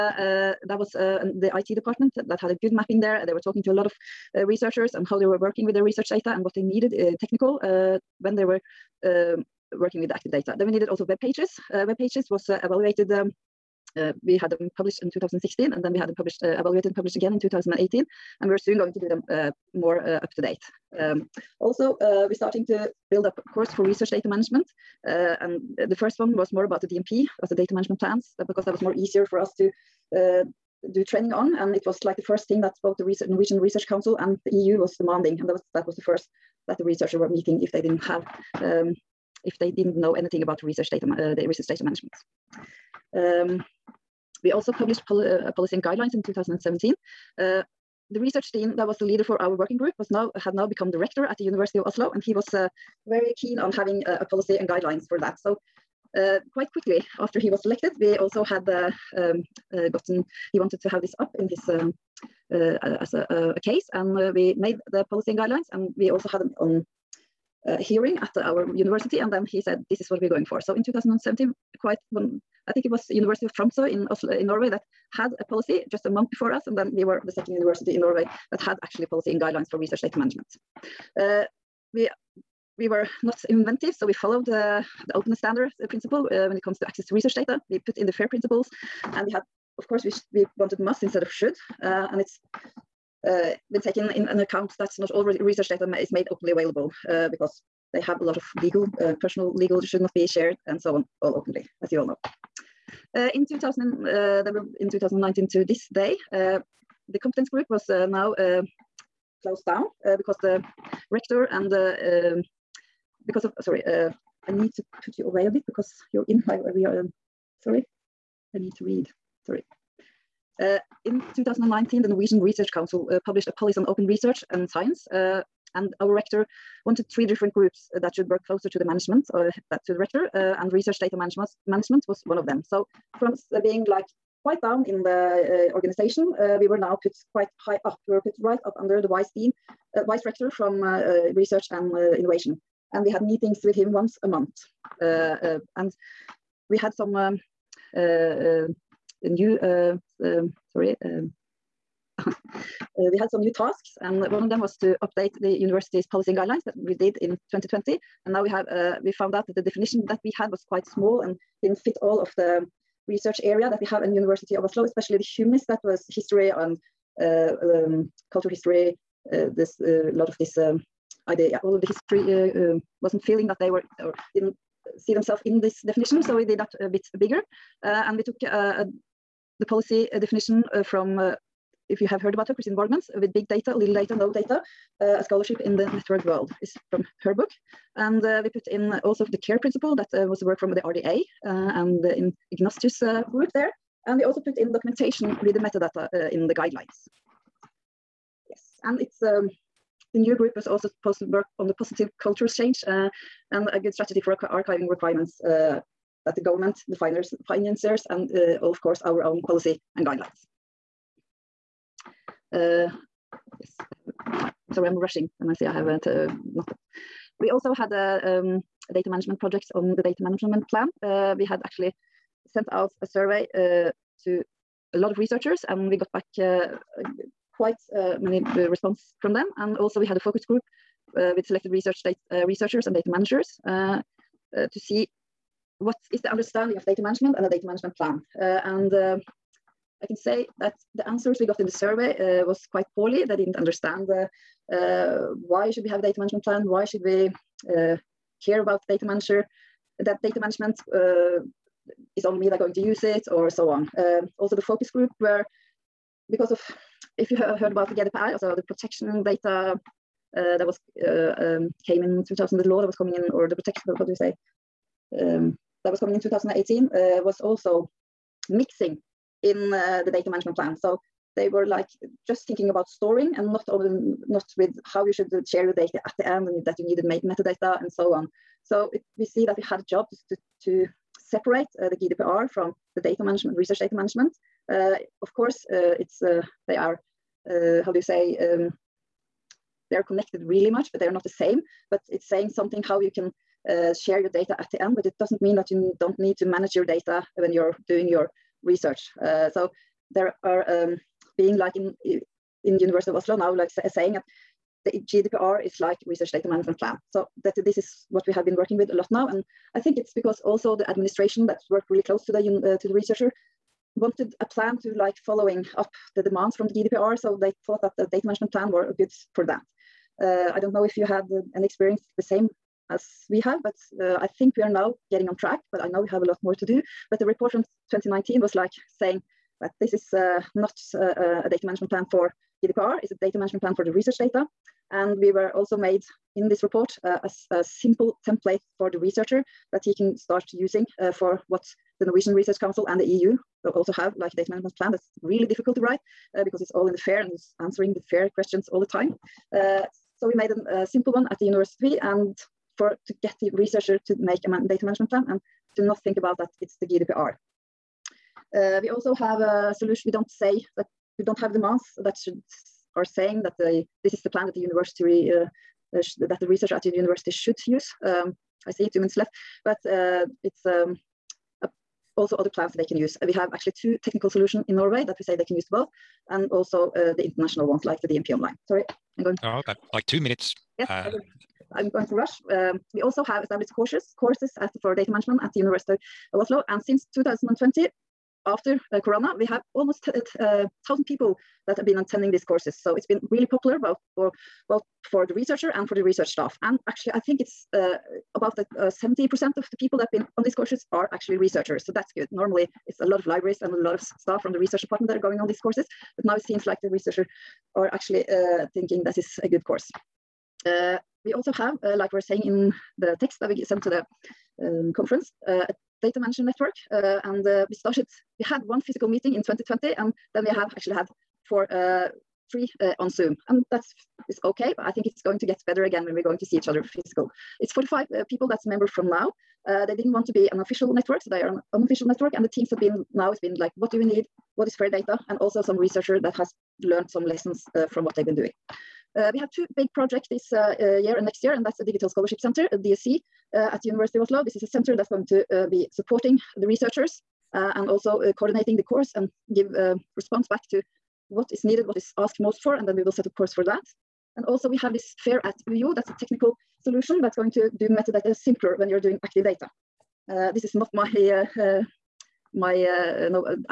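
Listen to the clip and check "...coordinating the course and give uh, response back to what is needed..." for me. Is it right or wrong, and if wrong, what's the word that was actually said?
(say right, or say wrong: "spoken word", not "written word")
right.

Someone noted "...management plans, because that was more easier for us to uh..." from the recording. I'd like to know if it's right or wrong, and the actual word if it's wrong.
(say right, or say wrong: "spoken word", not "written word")
right.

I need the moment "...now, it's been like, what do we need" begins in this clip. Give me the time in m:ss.
7:13.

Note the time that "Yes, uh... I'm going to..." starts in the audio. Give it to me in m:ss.
6:20.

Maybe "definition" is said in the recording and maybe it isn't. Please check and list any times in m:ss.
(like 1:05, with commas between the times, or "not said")
2:39, 2:55, 3:00.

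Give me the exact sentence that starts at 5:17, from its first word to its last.
So they thought that the data management plan were good for that.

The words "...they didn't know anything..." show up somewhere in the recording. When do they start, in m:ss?
0:39.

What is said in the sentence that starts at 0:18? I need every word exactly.
And we we're soon going to do them uh, more uh, up to date.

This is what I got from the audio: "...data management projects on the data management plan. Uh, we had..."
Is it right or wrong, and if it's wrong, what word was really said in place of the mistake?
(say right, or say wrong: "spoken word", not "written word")
right.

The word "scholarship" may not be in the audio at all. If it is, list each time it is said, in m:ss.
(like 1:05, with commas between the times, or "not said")
3:05, 7:22.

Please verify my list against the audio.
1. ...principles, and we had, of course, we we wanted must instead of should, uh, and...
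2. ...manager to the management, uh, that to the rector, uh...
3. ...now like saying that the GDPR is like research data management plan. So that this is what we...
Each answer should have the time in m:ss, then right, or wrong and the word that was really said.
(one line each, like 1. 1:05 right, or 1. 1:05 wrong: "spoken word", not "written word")
1. 1:28 right
2. 2:08 wrong: "closer", not "manager"
3. 5:03 right.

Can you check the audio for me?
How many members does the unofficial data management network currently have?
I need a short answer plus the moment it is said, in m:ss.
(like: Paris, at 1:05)
45, at 7:07.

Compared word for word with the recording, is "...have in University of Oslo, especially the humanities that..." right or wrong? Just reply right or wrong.
right.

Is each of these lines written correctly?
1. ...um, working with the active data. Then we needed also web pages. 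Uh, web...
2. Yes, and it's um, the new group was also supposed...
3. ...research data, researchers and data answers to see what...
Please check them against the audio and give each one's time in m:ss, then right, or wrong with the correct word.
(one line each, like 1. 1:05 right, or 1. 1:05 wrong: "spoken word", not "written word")
1. 0:09 right
2. 3:18 right
3. 3:51 wrong: "managers", not "answers".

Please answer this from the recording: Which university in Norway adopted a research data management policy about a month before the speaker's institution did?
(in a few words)
University of Tromsø.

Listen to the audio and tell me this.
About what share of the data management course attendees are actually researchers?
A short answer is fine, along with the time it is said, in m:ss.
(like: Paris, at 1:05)
70%, at 6:38.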